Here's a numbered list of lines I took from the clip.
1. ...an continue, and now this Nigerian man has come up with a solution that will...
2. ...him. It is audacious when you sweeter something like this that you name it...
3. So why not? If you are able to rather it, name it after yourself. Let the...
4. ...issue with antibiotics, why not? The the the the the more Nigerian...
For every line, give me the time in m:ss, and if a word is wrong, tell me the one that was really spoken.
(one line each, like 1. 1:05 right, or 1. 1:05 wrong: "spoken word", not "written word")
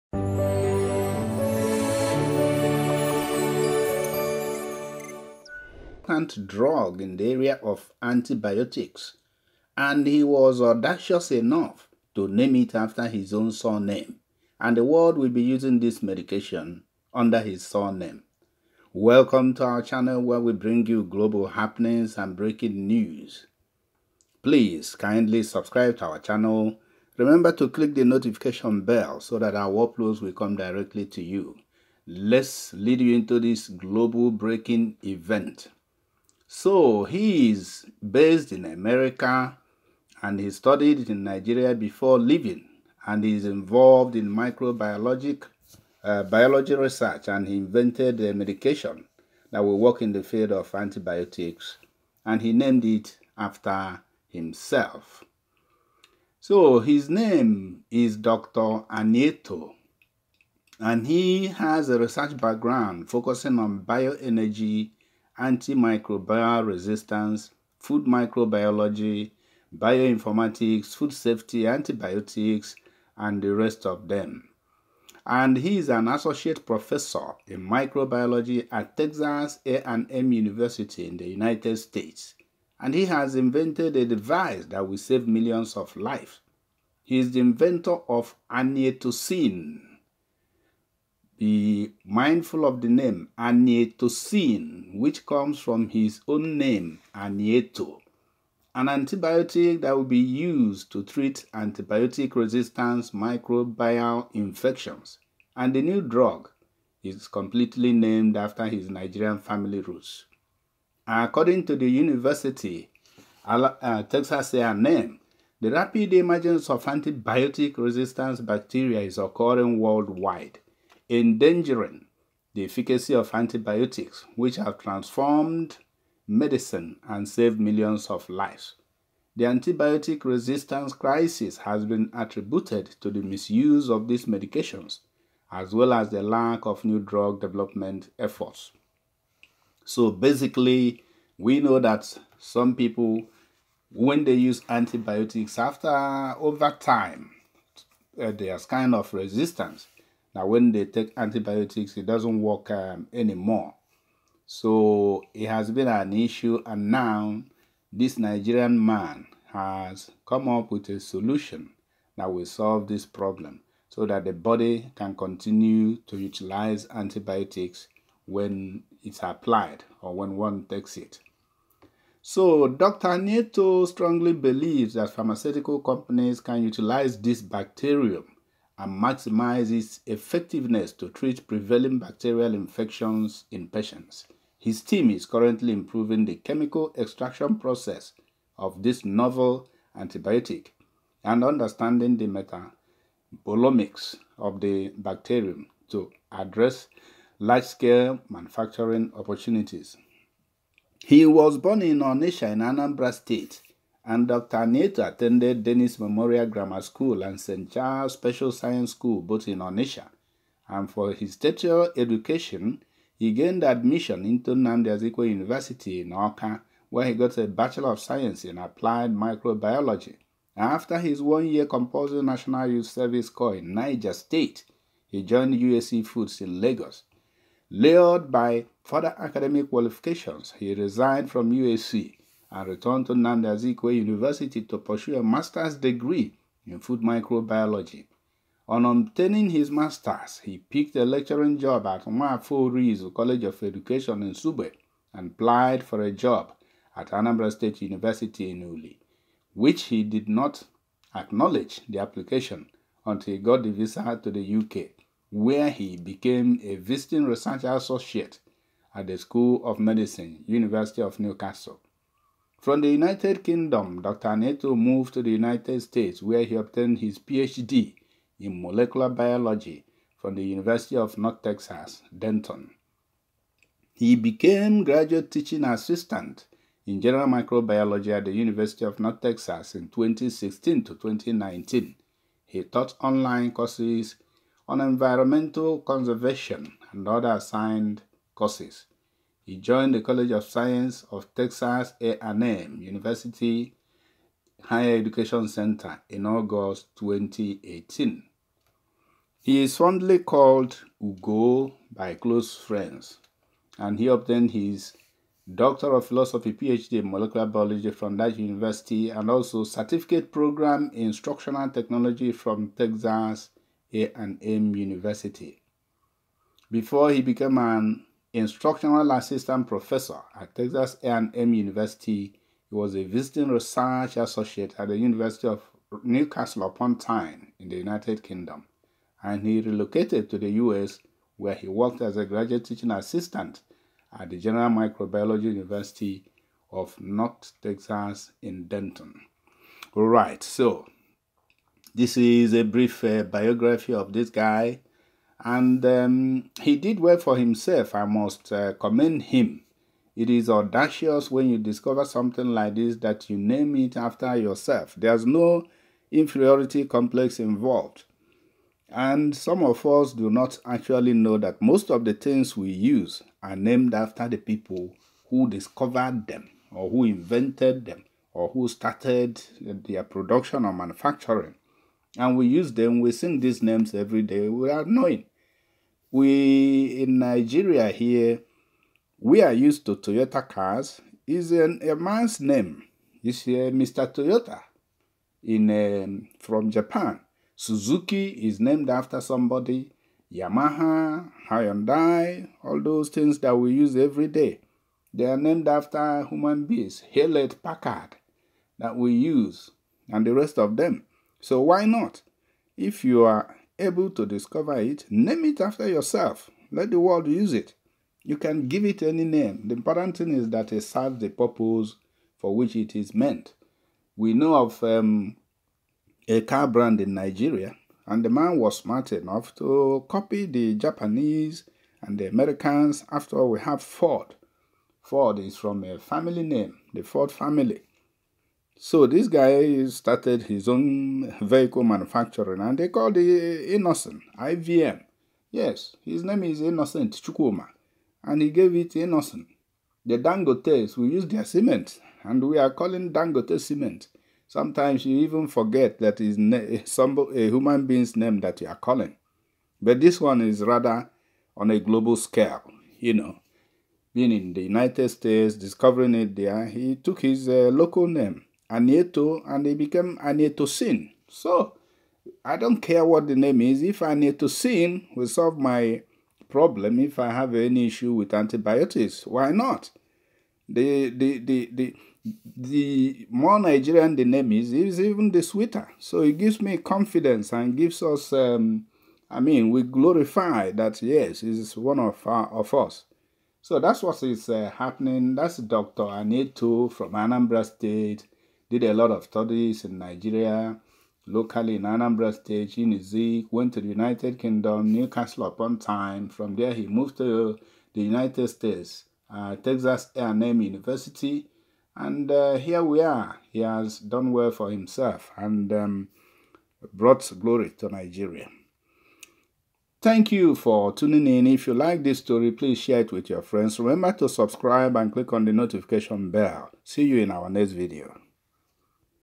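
1. 2:35 wrong: "issue", not "continue"
2. 5:49 wrong: "discover", not "sweeter"
3. 6:41 wrong: "discover", not "rather"
4. 7:47 right.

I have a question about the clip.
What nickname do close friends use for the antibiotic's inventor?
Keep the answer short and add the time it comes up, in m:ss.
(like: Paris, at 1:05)
Ugo, at 5:01.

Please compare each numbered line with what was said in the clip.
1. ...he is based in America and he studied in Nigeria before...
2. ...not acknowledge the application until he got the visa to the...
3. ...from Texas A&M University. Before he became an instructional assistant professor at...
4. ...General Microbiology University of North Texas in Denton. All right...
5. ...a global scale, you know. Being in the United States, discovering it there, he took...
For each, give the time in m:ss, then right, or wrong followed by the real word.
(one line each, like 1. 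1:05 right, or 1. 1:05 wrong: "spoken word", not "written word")
1. 0:37 right
2. 4:10 right
3. 5:12 right
4. 5:34 right
5. 7:31 right.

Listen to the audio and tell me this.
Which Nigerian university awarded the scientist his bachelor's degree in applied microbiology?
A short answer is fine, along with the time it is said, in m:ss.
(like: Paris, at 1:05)
Nnamdi Azikiwe University, at 3:34.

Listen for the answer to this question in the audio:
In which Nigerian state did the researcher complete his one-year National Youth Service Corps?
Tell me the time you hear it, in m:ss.
3:43.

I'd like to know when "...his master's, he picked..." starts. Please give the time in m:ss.
3:59.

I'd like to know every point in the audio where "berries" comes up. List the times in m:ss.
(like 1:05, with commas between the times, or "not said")
not said.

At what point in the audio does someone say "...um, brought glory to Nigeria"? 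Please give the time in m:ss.
8:25.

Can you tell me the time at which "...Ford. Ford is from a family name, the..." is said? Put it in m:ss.
7:03.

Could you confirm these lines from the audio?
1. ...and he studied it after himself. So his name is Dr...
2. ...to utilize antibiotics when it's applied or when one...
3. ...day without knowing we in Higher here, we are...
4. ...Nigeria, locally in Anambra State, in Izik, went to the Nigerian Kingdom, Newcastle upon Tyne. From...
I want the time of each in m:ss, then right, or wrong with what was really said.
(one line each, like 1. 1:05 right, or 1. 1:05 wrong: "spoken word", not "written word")
1. 0:52 wrong: "named", not "studied"
2. 2:46 right
3. 6:14 wrong: "Nigeria", not "Higher"
4. 8:09 wrong: "United", not "Nigerian".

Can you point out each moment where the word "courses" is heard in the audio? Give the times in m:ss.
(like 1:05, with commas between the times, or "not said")
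4:43, 4:48.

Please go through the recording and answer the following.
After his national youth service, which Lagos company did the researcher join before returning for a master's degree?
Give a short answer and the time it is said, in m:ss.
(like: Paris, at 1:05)
UAC Foods, at 3:45.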